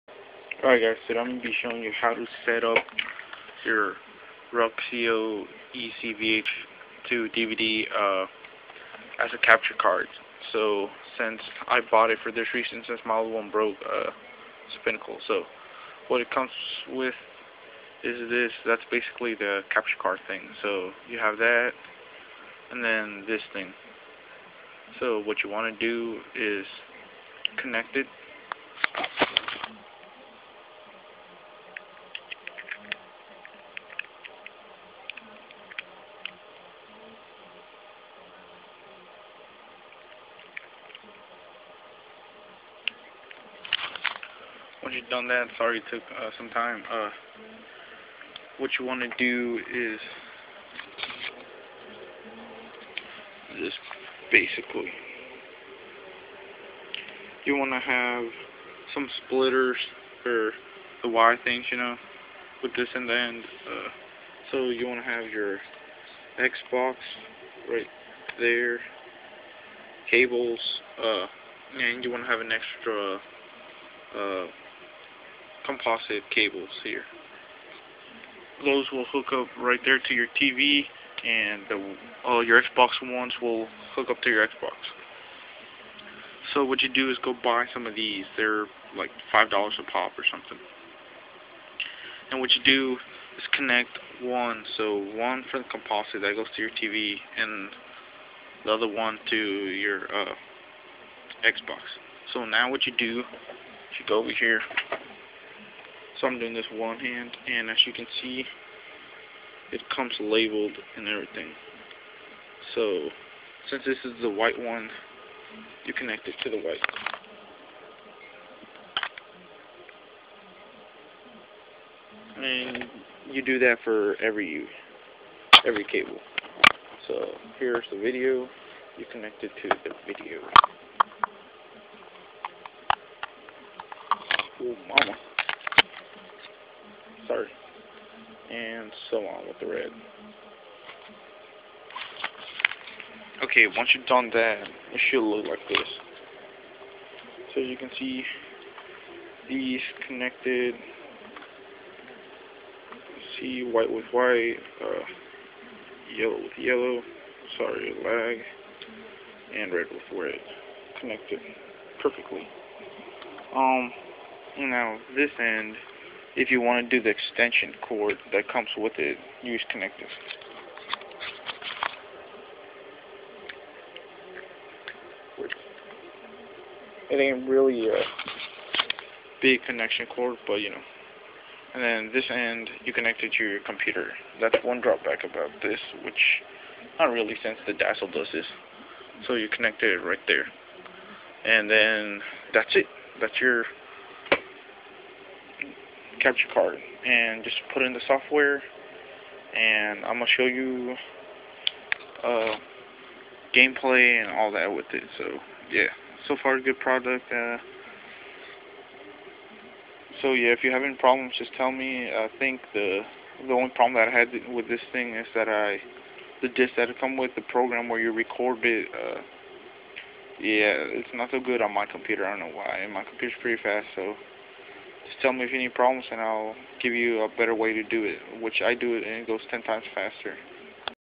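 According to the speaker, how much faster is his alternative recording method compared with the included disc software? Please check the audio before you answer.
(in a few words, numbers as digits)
10 times faster.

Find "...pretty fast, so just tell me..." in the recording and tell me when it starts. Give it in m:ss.
3:43.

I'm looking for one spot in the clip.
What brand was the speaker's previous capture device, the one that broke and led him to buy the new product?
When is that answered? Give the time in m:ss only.
0:14.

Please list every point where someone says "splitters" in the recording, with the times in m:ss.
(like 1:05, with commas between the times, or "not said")
0:59.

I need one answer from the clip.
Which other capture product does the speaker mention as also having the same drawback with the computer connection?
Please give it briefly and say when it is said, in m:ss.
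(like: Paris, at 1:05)
Dazzle, at 3:07.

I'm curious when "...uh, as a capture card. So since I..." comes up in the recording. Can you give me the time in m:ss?
0:07.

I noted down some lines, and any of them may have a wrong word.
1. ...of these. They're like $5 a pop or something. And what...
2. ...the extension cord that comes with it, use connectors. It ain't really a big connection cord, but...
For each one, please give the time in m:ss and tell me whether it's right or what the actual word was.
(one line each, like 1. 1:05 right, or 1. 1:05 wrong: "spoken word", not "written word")
1. 1:27 right
2. 2:47 right.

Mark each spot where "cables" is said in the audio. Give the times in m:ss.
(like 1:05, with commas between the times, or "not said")
1:10, 1:16, 2:05.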